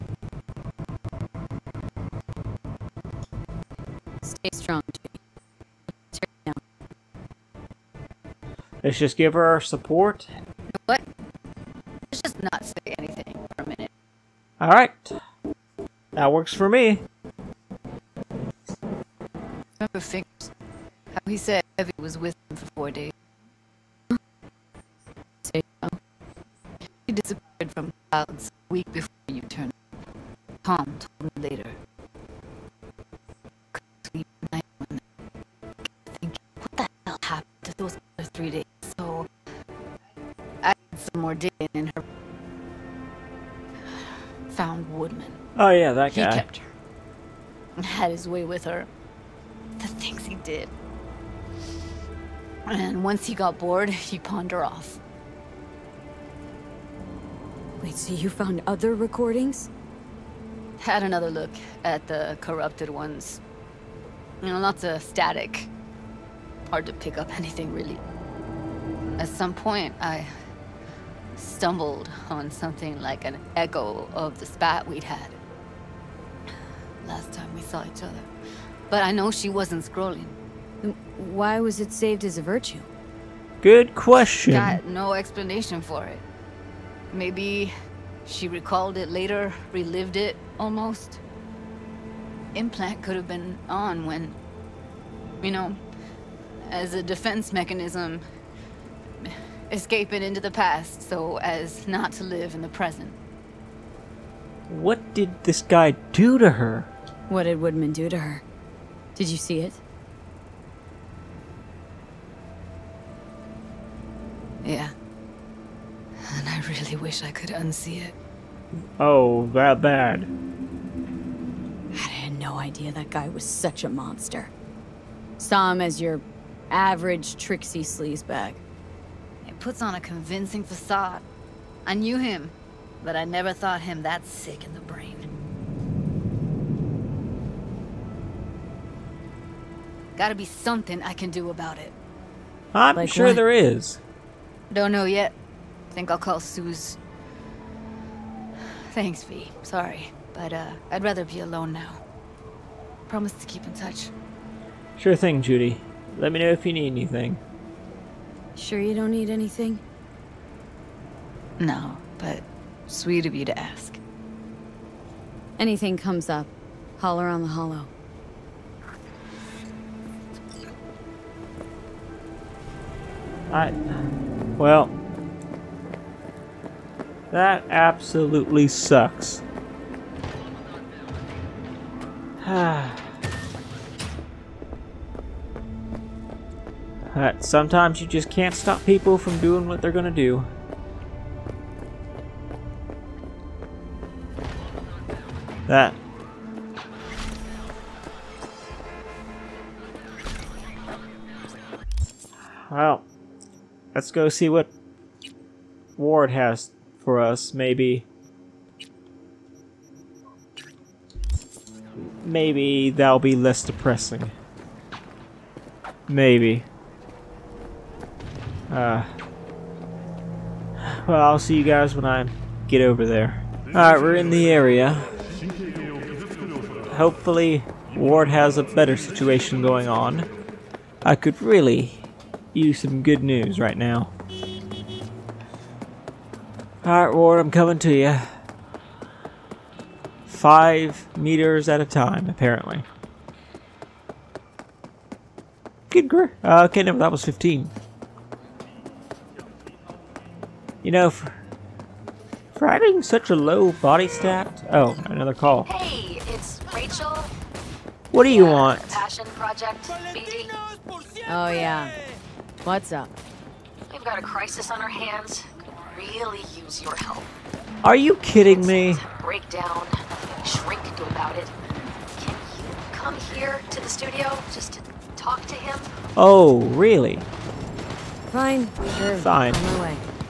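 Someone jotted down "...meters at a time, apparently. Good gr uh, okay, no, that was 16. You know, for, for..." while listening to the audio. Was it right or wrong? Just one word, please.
wrong.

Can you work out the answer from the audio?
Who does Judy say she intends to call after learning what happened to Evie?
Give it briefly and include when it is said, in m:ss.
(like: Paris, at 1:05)
Suze, at 2:26.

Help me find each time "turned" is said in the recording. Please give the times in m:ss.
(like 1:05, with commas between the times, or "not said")
0:29.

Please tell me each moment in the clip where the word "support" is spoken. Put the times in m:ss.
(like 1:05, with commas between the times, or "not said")
0:09.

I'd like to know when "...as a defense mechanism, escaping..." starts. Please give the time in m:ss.
1:36.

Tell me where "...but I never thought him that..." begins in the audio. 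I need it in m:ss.
2:13.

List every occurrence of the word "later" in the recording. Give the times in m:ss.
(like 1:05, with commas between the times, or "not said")
0:31, 1:29.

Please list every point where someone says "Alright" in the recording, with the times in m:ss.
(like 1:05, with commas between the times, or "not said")
3:43, 3:56.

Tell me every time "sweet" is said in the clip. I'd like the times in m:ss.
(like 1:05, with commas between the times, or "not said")
2:42.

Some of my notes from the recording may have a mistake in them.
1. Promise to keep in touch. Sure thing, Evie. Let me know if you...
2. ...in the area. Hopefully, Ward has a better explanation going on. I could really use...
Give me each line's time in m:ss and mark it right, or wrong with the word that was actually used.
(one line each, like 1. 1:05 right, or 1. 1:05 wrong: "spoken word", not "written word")
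1. 2:33 wrong: "Judy", not "Evie"
2. 3:44 wrong: "situation", not "explanation".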